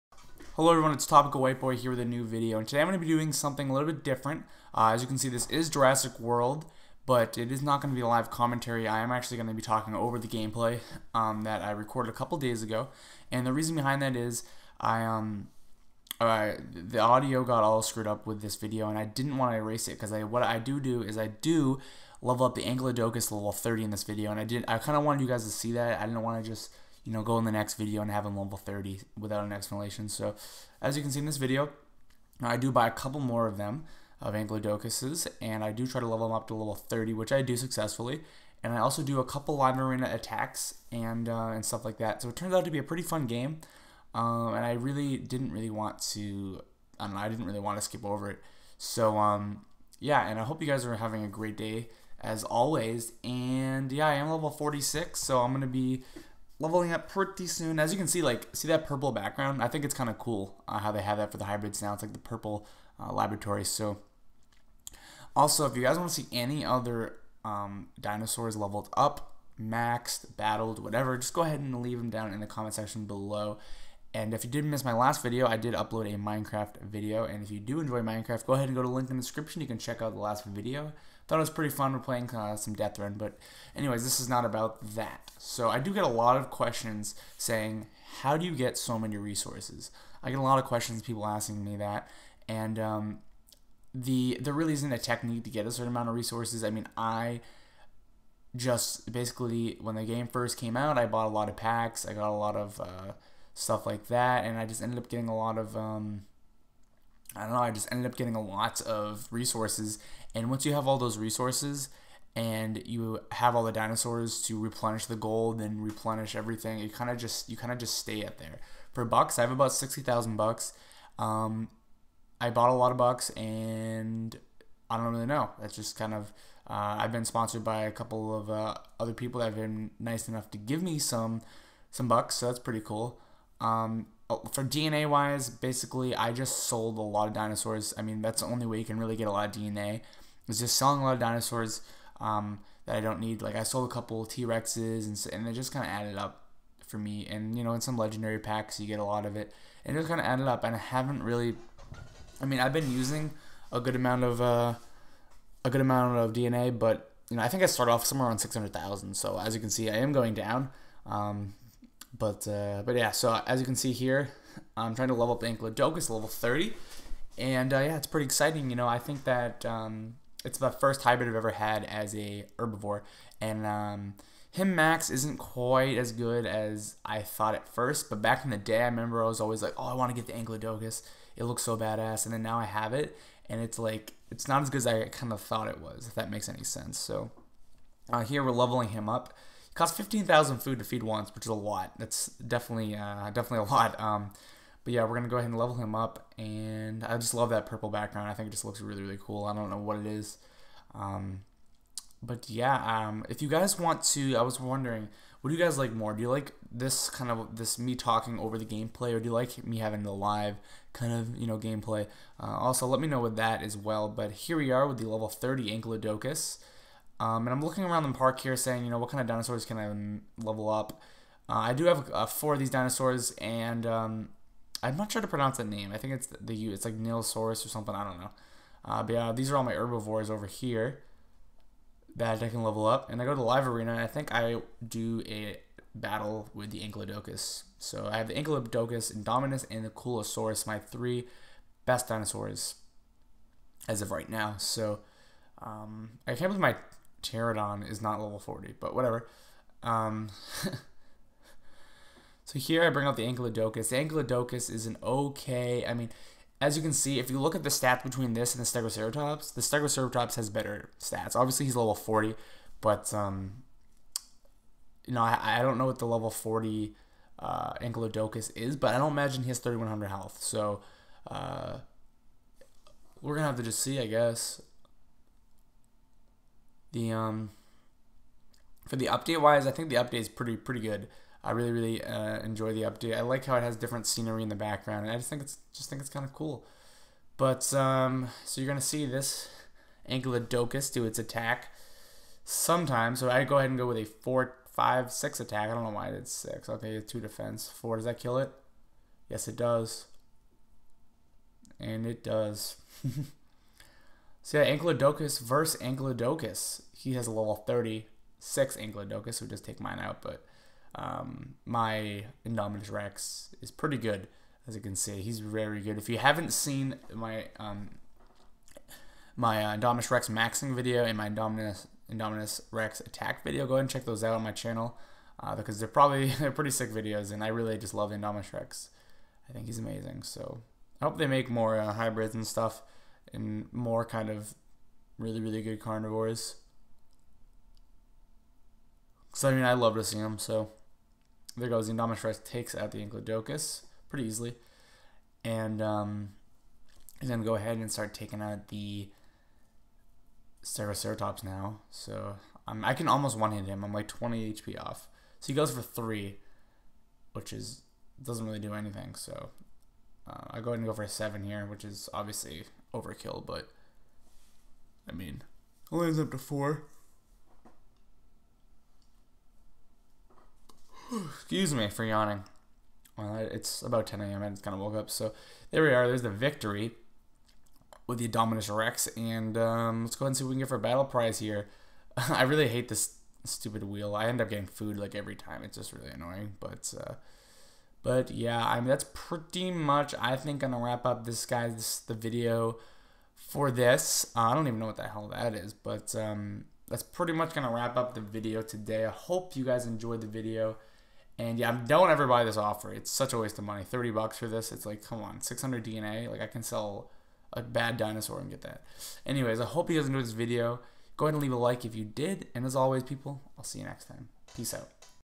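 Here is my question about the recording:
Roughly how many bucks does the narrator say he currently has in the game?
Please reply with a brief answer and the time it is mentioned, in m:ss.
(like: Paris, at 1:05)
60,000, at 1:59.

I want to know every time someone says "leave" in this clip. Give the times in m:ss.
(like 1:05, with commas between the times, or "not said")
1:11, 6:51.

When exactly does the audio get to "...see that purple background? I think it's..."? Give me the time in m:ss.
0:58.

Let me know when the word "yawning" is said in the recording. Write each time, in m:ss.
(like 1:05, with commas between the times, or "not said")
6:12.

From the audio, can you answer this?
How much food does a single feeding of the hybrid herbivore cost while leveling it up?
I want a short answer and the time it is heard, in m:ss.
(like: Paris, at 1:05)
15,000, at 3:09.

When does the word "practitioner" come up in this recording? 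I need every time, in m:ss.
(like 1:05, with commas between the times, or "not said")
not said.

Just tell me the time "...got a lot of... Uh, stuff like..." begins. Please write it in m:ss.
1:42.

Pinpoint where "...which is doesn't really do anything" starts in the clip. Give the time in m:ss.
5:57.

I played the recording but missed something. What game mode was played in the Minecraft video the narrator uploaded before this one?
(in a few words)
Death Run.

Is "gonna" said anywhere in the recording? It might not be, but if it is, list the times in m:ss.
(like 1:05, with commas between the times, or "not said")
3:15, 4:48.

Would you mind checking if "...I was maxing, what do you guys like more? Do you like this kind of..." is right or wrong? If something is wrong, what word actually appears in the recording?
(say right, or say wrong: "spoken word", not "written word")
wrong: "wondering", not "maxing".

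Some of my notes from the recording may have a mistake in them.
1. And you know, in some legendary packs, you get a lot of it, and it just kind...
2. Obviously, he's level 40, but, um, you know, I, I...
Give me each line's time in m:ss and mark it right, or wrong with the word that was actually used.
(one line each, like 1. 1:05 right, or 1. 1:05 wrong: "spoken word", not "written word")
1. 2:27 right
2. 4:21 right.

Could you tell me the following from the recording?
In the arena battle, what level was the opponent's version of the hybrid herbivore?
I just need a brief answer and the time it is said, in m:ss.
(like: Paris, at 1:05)
36, at 5:07.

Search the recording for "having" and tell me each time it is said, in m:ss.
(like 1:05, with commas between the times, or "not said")
0:50, 3:29.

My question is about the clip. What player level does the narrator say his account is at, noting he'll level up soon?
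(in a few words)
46.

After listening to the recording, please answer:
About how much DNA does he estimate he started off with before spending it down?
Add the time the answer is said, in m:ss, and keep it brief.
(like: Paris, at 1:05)
600,000, at 2:38.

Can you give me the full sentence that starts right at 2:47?
And uh, yeah, it's pretty exciting.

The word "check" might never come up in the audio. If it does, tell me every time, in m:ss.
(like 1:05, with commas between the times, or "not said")
1:19, 5:23.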